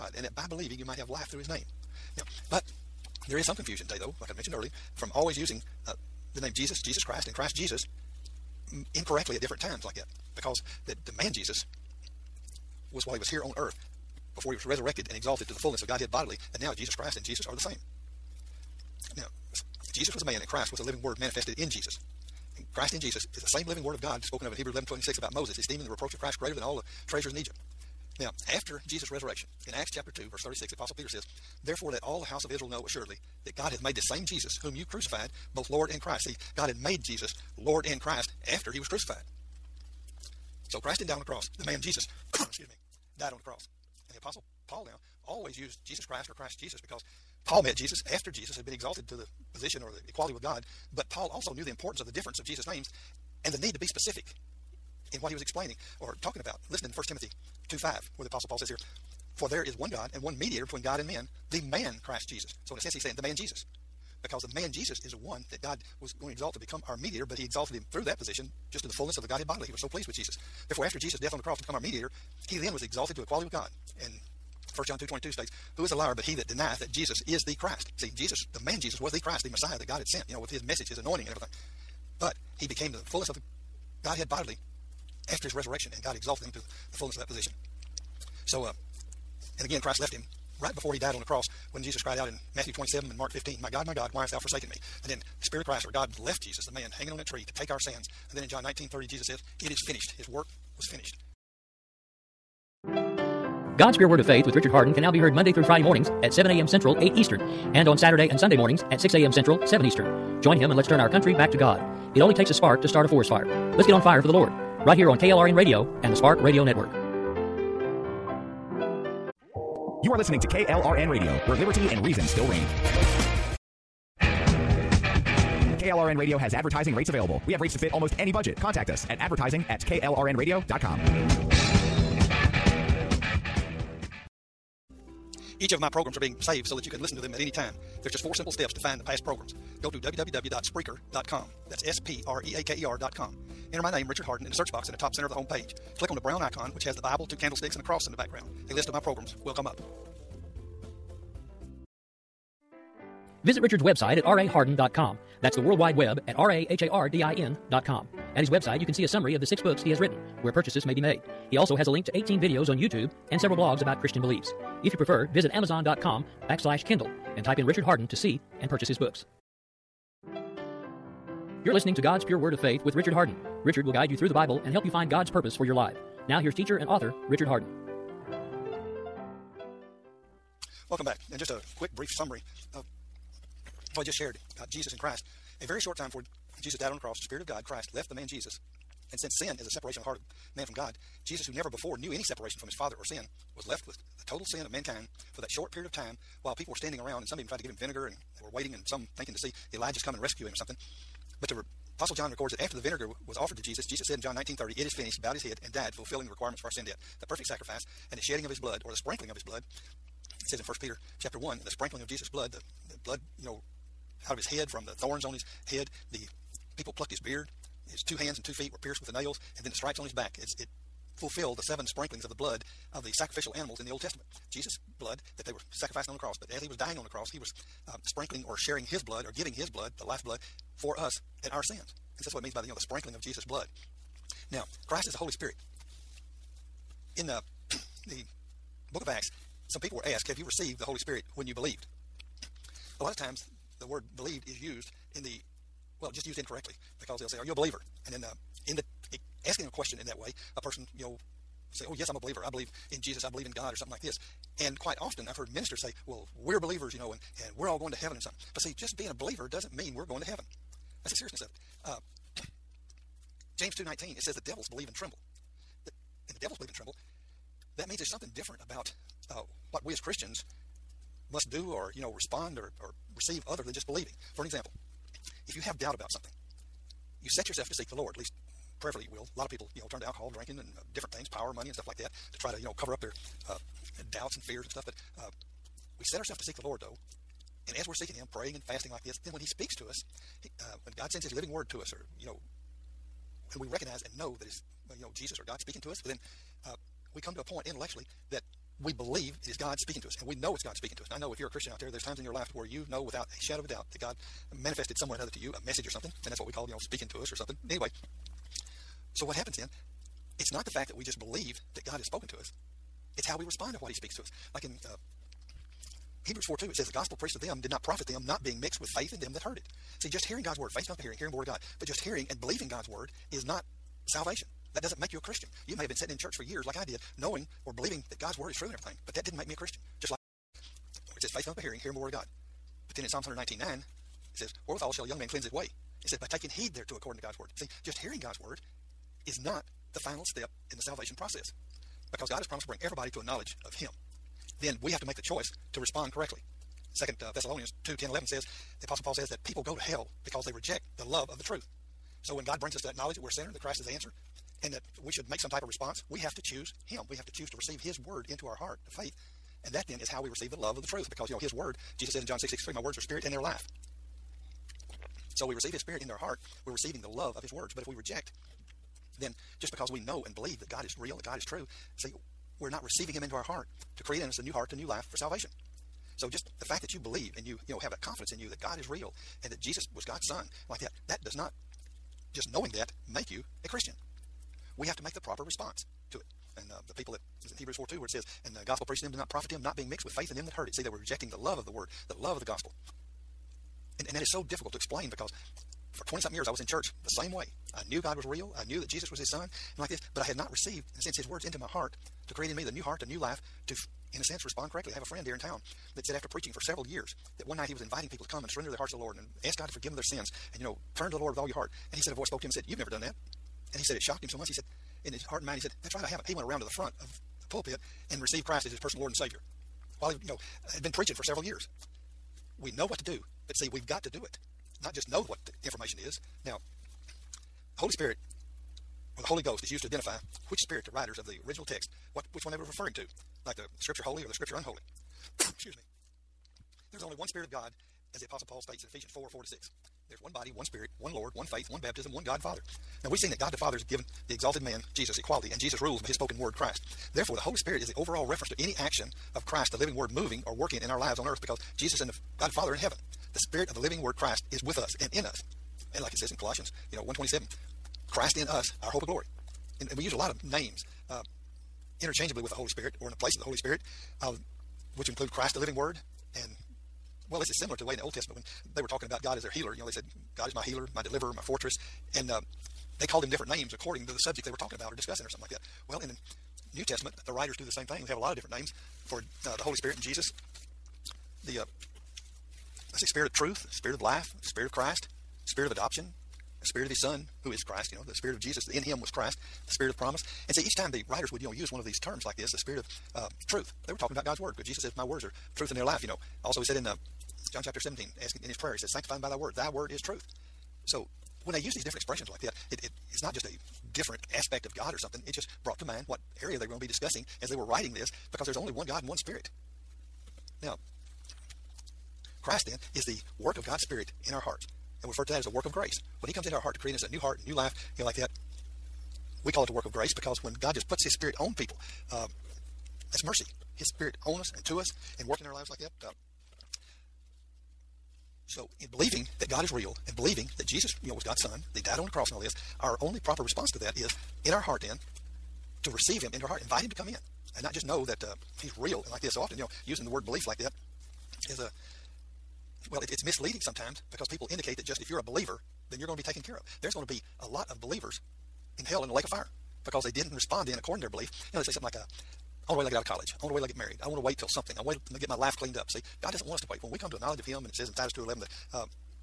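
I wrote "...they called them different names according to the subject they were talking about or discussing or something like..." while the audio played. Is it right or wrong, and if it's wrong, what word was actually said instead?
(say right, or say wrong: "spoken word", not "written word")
right.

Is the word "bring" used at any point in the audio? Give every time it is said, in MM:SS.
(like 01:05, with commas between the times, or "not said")
05:42, 05:52.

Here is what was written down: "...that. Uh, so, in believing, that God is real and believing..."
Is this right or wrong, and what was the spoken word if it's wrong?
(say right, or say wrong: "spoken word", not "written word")
right.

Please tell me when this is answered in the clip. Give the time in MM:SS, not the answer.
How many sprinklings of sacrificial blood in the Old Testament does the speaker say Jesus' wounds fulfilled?
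03:41.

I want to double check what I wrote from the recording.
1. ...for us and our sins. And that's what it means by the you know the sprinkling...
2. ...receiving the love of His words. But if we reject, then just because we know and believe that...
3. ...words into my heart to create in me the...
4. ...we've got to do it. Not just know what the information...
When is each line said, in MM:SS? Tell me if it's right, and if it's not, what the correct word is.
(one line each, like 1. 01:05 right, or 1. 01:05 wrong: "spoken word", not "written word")
1. 03:50 right
2. 06:06 right
3. 06:41 right
4. 07:03 right.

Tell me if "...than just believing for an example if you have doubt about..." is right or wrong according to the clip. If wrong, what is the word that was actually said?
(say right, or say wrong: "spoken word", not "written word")
right.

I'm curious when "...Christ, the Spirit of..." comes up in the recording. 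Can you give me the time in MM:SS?
08:09.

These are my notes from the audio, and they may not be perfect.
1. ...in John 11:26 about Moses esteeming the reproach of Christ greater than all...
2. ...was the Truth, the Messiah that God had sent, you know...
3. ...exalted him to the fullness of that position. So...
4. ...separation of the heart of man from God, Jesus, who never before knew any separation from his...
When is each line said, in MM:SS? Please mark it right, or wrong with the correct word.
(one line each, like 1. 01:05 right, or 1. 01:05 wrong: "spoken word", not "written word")
1. 00:24 wrong: "Hebrews", not "John"
2. 01:18 wrong: "Christ", not "Truth"
3. 01:26 right
4. 03:09 right.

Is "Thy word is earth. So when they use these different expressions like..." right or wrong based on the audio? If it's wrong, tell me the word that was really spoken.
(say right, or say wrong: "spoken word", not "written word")
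wrong: "truth", not "earth".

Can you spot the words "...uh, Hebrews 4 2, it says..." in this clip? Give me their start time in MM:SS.
05:14.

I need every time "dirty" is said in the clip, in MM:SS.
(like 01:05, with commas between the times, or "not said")
not said.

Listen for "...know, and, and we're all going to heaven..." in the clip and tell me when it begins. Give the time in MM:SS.
04:16.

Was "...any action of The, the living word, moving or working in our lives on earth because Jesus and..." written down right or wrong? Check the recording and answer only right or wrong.
wrong.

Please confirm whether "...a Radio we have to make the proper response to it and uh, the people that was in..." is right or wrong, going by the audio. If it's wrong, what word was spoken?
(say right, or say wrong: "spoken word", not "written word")
wrong: "Christian", not "Radio".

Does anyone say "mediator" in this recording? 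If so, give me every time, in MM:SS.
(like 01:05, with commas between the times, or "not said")
01:00, 01:06, 01:11.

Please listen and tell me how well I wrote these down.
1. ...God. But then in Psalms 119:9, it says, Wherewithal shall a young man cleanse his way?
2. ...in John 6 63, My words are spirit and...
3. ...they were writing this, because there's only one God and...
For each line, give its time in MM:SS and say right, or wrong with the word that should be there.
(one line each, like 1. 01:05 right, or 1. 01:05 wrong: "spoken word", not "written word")
1. 05:32 right
2. 06:02 right
3. 08:27 right.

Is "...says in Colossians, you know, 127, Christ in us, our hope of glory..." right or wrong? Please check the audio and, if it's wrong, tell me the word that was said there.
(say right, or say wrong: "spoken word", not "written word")
right.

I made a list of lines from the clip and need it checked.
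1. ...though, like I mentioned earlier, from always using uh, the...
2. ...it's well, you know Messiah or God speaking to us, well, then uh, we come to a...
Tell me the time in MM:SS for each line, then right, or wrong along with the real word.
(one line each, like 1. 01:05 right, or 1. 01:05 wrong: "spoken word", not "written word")
1. 00:03 right
2. 04:54 wrong: "Jesus", not "Messiah".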